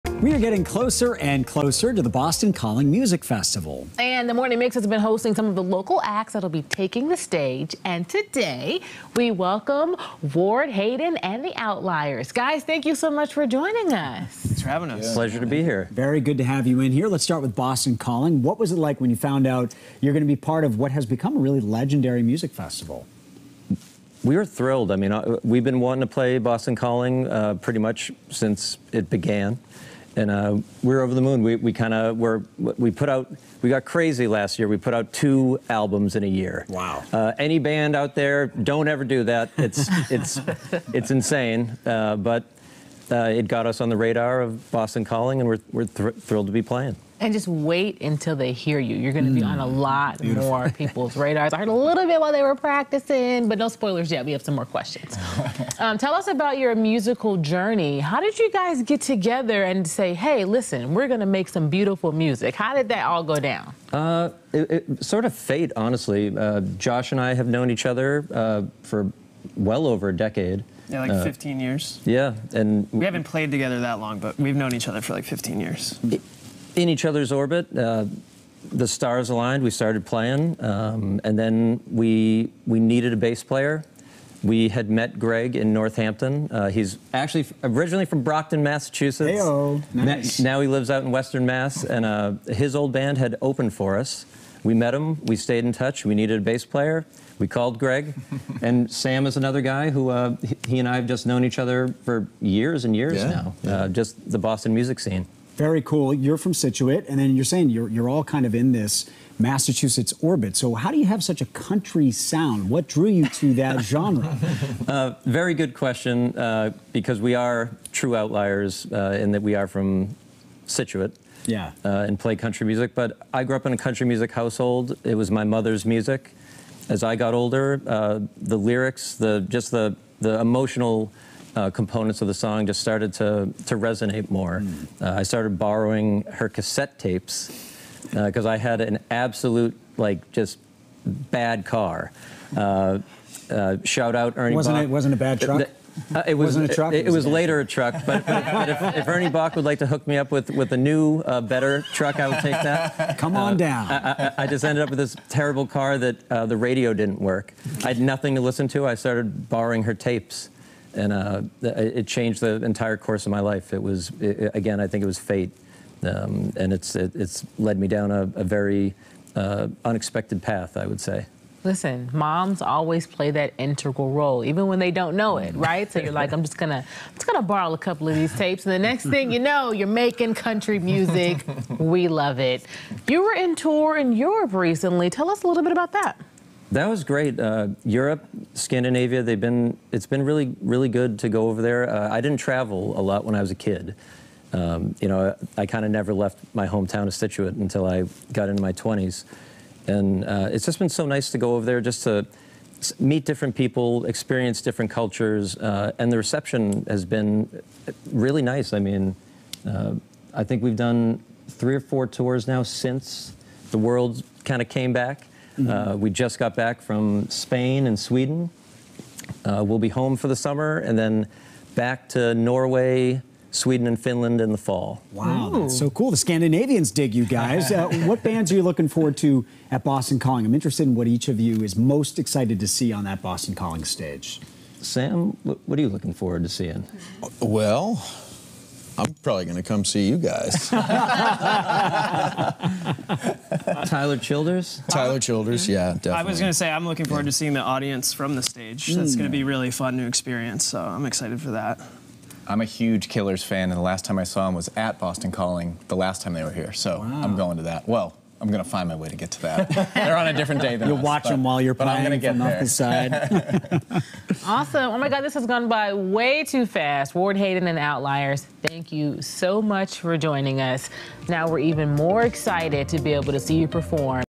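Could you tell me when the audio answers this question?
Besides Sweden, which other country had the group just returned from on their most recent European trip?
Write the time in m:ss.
3:37.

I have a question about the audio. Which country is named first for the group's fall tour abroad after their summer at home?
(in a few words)
Norway.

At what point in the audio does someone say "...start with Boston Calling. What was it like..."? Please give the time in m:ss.
0:17.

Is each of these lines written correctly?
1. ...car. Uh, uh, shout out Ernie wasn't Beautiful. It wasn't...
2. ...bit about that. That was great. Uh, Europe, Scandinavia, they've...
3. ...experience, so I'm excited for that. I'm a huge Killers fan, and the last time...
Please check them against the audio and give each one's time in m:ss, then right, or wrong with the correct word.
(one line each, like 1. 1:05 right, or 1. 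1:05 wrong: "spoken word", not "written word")
1. 2:21 wrong: "Boch", not "Beautiful"
2. 3:05 right
3. 4:10 right.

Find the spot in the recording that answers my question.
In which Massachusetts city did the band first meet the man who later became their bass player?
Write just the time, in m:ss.
1:25.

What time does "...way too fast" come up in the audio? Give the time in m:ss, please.
4:25.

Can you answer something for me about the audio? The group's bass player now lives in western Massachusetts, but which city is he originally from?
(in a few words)
Brockton.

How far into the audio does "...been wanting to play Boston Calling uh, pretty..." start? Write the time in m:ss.
0:25.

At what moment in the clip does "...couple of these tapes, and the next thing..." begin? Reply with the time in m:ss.
2:57.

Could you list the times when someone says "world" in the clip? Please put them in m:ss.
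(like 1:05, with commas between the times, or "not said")
3:33.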